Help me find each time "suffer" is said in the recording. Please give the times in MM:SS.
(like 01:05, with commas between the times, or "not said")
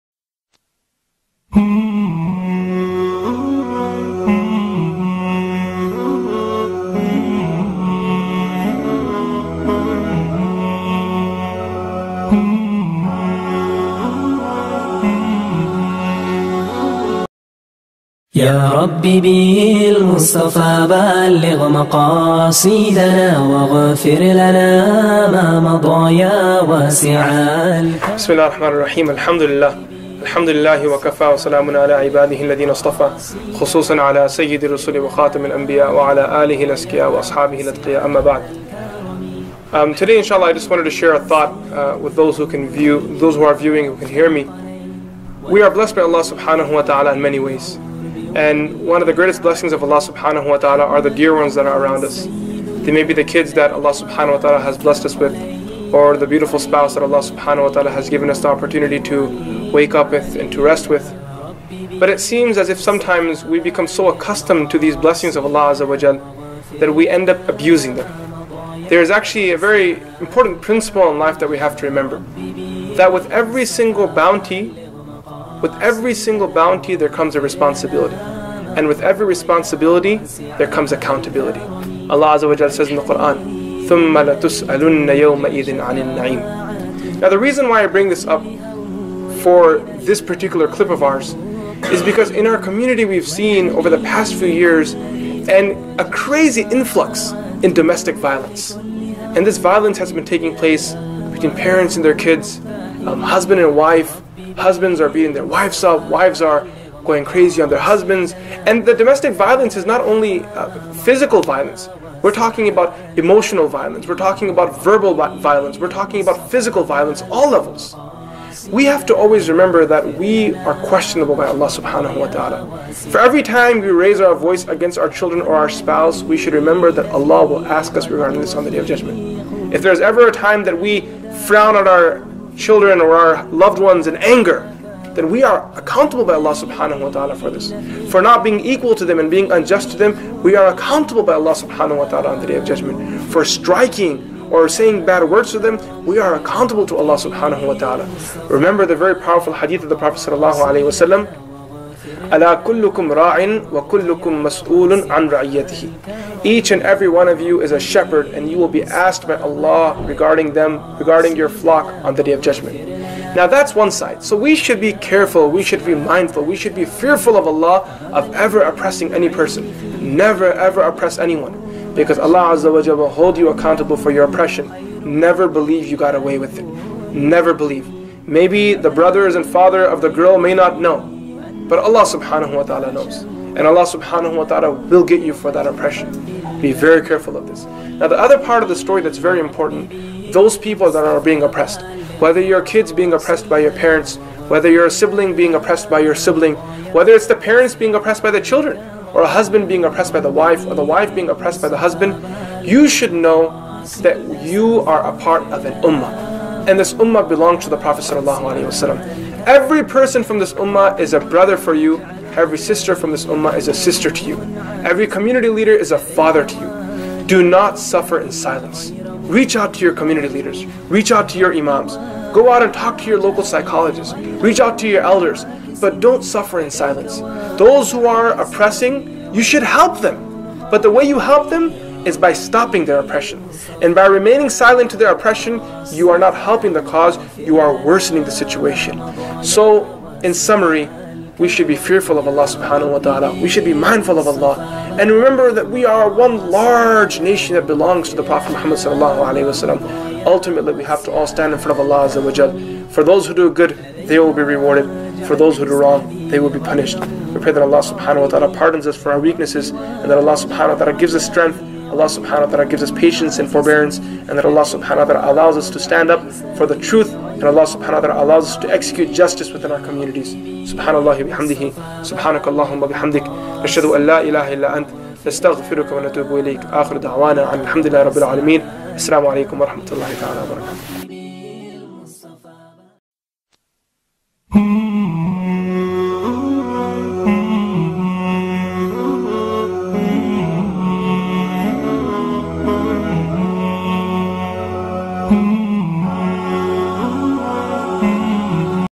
03:37, 03:46.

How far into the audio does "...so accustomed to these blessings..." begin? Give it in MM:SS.
01:03.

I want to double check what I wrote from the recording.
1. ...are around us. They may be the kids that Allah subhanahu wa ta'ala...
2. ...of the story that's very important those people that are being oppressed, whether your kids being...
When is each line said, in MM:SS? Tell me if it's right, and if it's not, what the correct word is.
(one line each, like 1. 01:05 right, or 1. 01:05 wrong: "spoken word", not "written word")
1. 00:51 right
2. 03:08 right.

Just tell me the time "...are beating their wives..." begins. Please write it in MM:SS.
01:44.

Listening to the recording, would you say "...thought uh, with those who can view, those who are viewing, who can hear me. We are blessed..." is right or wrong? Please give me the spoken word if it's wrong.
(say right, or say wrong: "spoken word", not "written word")
right.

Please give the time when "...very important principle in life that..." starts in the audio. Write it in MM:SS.
01:09.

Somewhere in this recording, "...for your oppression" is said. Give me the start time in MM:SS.
02:53.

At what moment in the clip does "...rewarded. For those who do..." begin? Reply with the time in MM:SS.
04:14.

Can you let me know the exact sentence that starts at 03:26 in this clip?
And this ummah belongs to the Prophet.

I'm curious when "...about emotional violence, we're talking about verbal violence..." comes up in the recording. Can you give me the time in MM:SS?
01:52.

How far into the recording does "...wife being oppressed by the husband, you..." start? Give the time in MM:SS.
03:20.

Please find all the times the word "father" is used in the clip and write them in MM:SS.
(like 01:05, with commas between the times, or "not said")
02:59, 03:35.